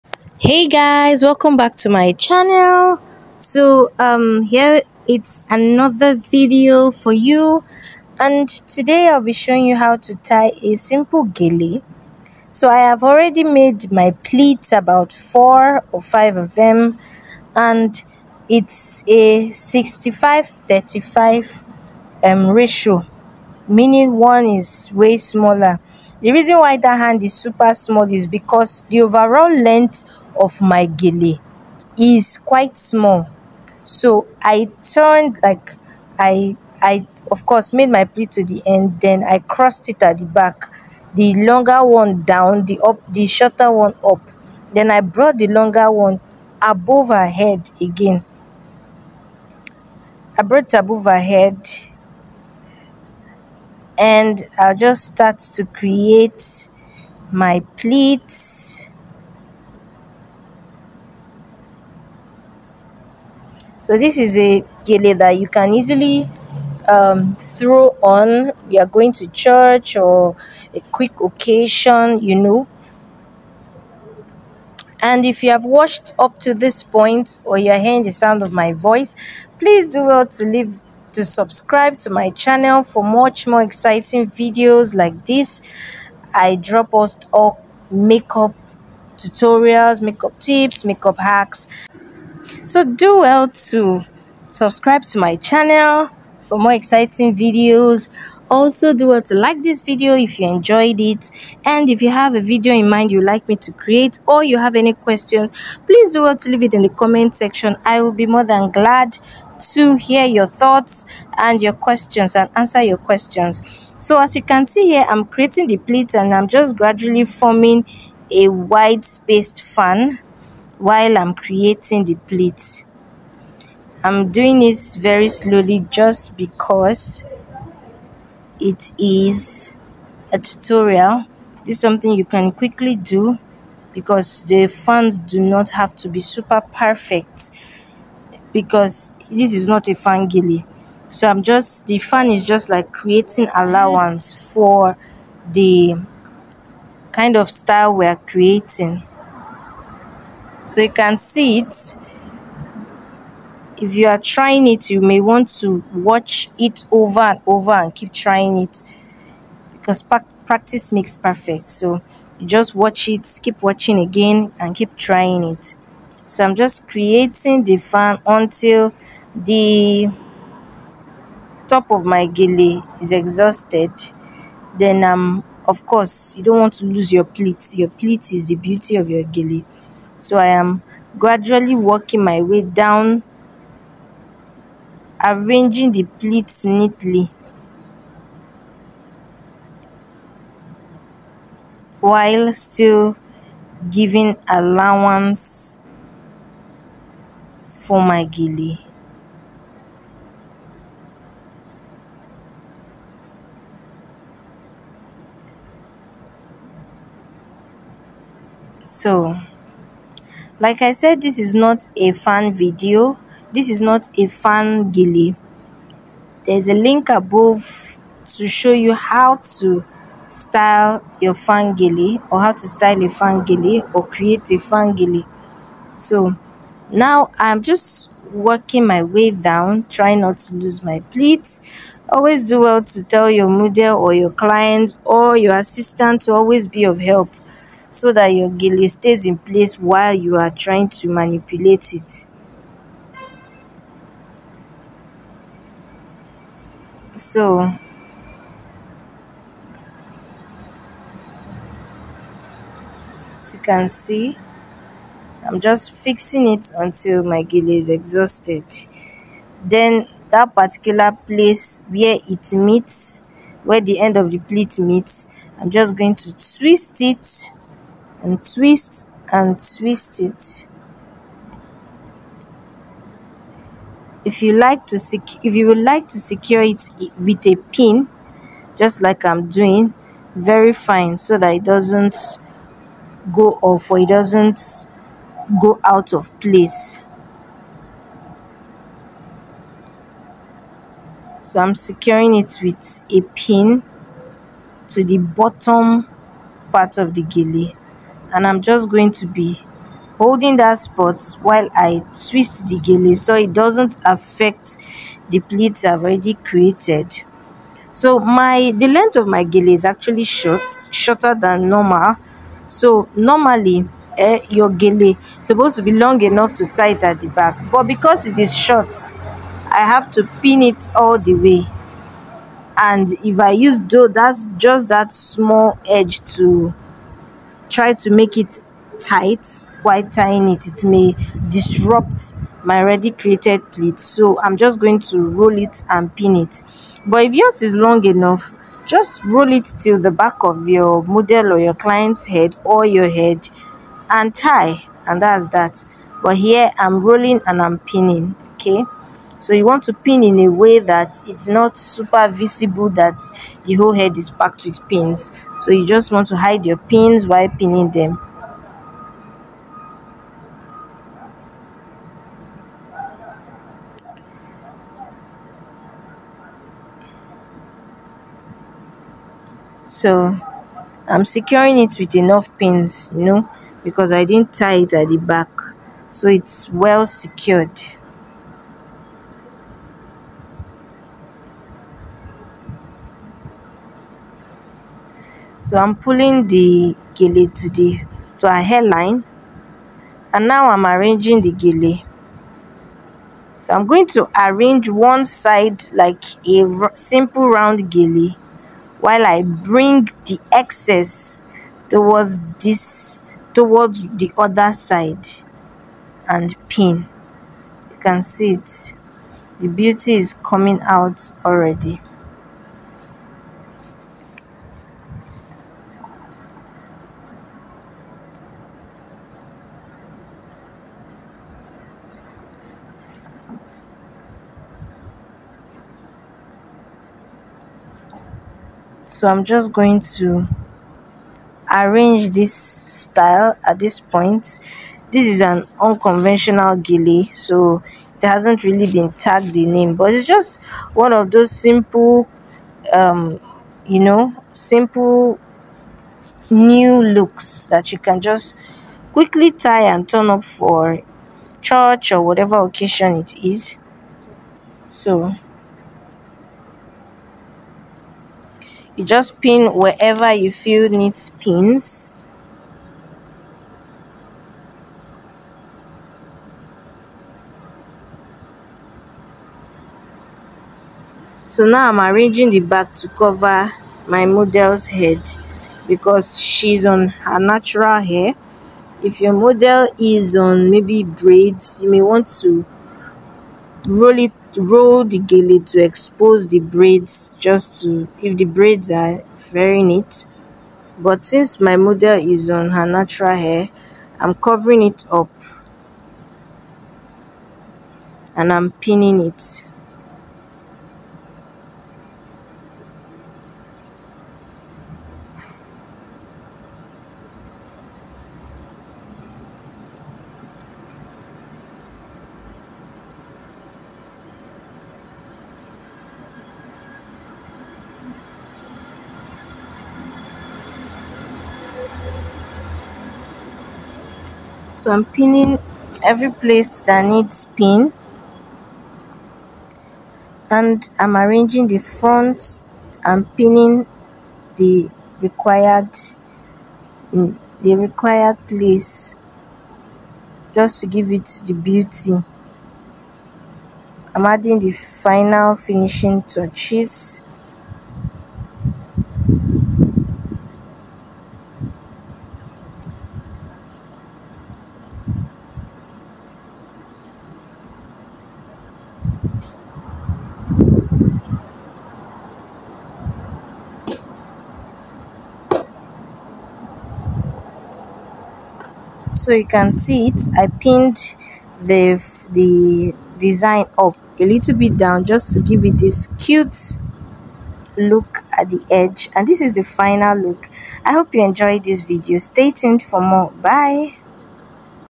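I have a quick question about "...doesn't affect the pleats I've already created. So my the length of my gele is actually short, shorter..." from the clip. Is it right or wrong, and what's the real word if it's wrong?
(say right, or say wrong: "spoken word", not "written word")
right.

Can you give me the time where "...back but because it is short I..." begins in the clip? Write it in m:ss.
5:17.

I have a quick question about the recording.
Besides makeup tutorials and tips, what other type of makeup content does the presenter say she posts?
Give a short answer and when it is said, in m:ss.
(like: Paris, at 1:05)
makeup hacks, at 1:30.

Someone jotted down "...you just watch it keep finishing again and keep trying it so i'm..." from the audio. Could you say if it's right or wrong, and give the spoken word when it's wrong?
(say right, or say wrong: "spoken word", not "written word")
wrong: "watching", not "finishing".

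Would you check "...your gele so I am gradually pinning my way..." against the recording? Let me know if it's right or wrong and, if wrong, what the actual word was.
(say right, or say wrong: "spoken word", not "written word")
wrong: "working", not "pinning".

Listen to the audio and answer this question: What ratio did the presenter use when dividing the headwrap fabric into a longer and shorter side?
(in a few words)
65 35.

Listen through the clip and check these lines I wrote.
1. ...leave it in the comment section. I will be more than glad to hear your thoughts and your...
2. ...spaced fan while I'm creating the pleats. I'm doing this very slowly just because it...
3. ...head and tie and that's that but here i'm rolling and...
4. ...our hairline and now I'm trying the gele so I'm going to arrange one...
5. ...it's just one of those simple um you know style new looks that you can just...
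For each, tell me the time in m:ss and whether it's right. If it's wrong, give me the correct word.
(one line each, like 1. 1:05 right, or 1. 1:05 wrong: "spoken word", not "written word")
1. 1:46 right
2. 1:59 right
3. 5:43 right
4. 6:28 wrong: "arranging", not "trying"
5. 7:20 wrong: "simple", not "style".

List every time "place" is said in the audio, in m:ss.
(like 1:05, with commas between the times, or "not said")
3:59, 4:21, 4:46, 8:46, 8:58.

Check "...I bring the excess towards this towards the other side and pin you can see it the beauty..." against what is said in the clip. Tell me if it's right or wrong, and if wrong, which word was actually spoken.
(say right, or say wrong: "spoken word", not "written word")
right.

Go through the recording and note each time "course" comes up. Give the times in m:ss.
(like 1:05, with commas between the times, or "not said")
0:37, 2:55.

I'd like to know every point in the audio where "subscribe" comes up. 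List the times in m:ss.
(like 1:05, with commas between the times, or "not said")
1:21, 1:34.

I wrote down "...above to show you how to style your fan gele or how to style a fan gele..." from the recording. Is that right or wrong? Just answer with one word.
right.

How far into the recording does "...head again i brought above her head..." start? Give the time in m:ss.
0:47.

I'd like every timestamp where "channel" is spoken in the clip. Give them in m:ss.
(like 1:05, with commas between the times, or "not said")
0:02, 1:22, 1:35.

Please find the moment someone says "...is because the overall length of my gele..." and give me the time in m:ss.
0:28.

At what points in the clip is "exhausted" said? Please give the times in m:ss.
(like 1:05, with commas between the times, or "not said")
2:53, 4:17.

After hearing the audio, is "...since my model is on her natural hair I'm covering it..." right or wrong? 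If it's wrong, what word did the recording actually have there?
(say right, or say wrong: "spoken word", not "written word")
right.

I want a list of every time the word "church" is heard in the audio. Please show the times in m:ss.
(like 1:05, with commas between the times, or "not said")
1:09, 7:31.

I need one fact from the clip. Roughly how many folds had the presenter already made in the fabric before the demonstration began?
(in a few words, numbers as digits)
four or five.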